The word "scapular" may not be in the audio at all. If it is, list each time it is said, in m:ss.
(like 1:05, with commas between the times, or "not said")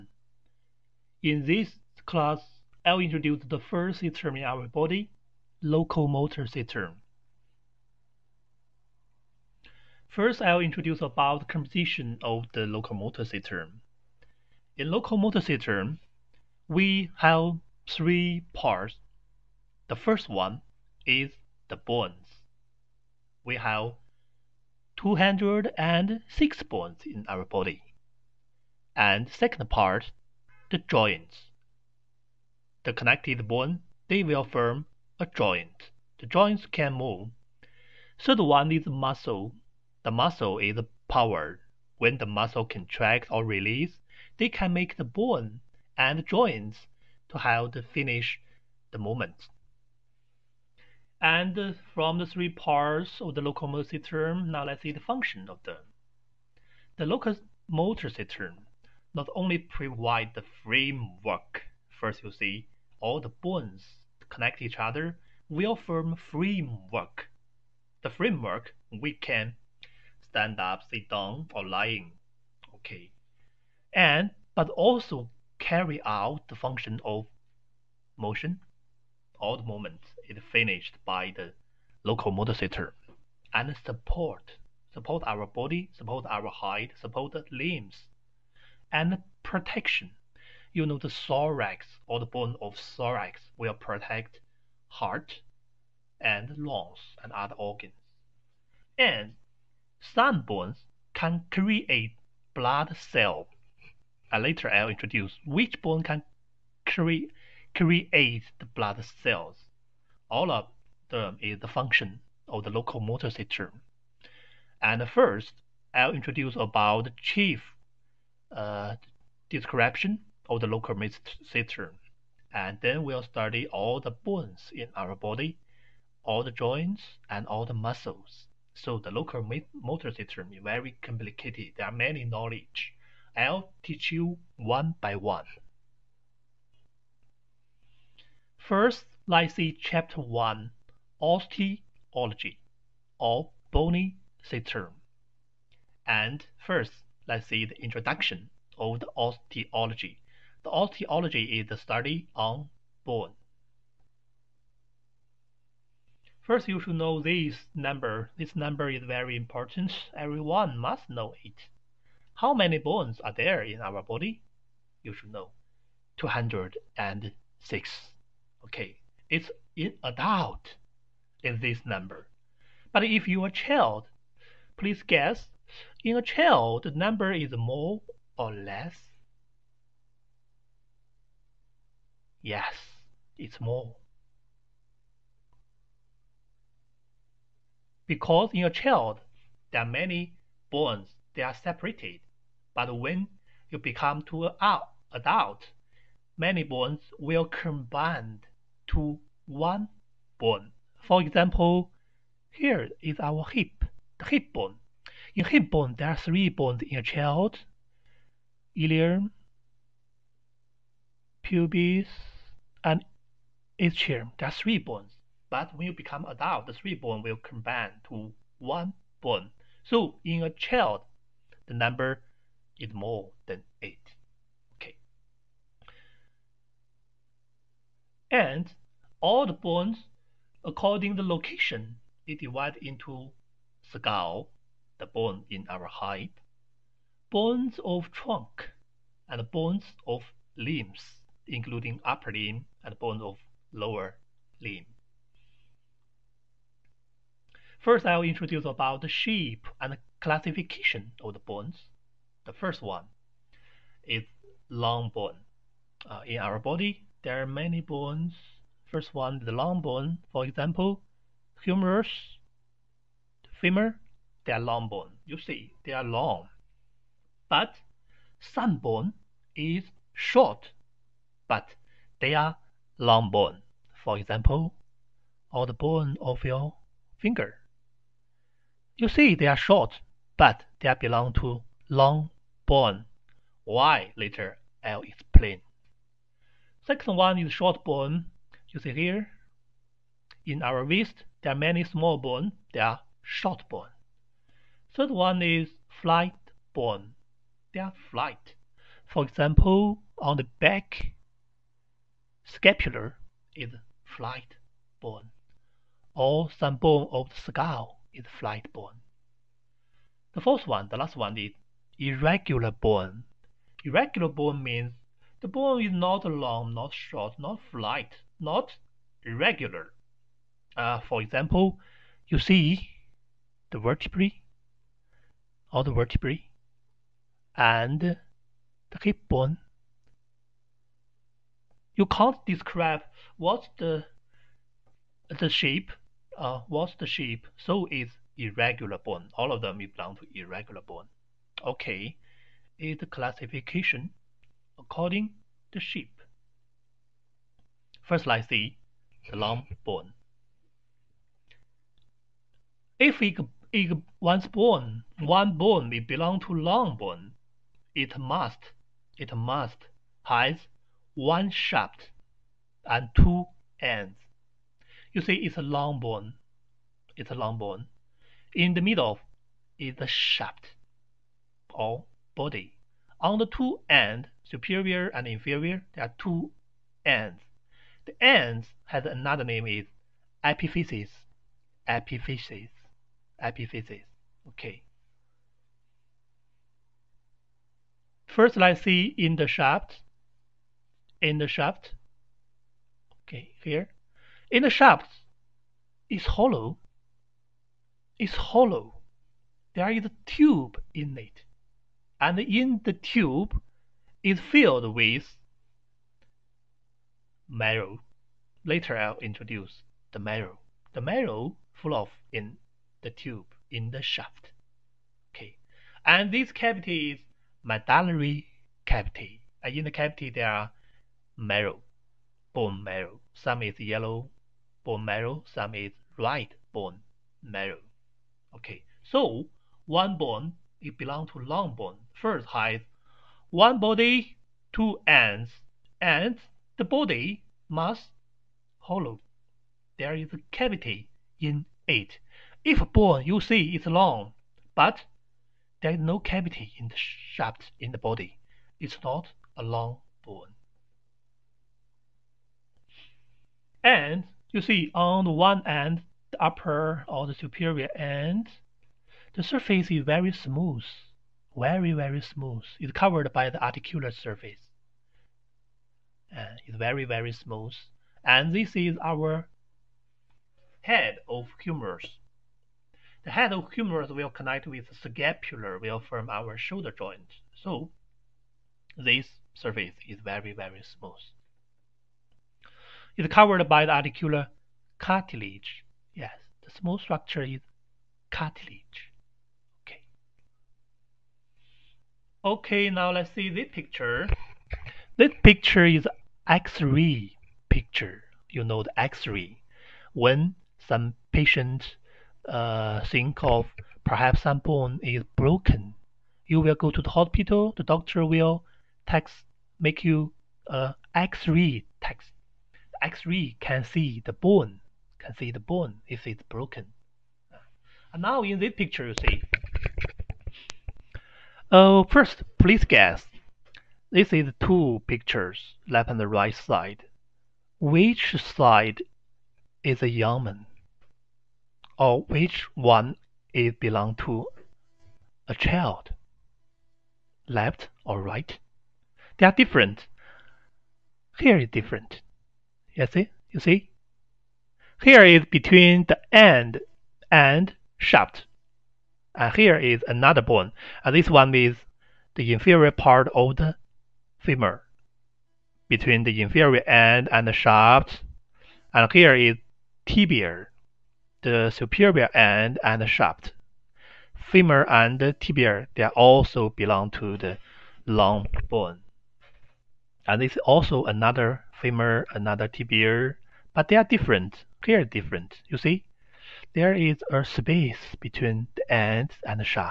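5:02, 7:55.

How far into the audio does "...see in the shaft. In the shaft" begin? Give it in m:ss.
6:28.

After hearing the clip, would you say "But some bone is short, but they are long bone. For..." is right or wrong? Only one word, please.
right.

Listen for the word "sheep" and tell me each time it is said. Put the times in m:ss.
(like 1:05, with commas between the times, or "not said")
5:45.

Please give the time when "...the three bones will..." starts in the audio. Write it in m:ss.
3:36.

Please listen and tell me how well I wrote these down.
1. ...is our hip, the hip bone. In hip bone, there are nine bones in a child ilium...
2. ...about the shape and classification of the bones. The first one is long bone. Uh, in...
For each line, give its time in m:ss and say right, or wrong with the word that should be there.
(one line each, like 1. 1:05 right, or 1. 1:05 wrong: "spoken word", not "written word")
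1. 3:23 wrong: "three", not "nine"
2. 4:08 right.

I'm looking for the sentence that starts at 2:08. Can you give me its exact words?
So the local motor system is very complicated.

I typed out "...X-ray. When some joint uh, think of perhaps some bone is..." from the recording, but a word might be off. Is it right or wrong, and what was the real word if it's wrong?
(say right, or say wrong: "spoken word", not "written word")
wrong: "patient", not "joint".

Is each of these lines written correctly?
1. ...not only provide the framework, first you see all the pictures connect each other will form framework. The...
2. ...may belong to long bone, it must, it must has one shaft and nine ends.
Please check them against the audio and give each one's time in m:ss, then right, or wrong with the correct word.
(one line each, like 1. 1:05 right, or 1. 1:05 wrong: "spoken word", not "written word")
1. 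0:59 wrong: "bones", not "pictures"
2. 5:55 wrong: "two", not "nine".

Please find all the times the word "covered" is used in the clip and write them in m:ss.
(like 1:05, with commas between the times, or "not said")
7:42, 8:03.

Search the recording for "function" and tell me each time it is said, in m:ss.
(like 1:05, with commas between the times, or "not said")
0:54, 1:16, 1:51.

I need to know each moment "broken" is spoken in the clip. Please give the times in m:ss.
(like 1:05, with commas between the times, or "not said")
8:25, 8:36.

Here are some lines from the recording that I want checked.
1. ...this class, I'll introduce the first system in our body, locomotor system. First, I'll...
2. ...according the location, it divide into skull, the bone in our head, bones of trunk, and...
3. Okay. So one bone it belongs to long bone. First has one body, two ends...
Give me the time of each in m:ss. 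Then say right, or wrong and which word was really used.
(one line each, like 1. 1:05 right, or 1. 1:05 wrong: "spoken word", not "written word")
1. 0:01 right
2. 3:50 right
3. 7:08 right.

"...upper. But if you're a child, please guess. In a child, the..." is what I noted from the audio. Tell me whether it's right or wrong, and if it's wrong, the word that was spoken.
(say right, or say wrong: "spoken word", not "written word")
wrong: "number", not "upper".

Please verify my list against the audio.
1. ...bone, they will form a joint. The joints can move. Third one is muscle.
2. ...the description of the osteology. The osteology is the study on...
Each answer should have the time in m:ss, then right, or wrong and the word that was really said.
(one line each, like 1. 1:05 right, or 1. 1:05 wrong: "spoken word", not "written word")
1. 0:33 right
2. 2:27 wrong: "introduction", not "description".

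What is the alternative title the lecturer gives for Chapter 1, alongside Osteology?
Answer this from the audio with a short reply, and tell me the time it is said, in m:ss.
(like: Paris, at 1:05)
Bony System, at 2:23.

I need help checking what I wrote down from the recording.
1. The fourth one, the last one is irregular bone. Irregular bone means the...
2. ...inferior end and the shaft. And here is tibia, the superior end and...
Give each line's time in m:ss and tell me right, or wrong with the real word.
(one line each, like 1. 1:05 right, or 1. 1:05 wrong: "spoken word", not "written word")
1. 5:10 right
2. 9:16 right.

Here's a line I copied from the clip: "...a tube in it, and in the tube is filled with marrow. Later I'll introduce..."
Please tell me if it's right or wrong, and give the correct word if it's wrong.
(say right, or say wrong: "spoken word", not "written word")
right.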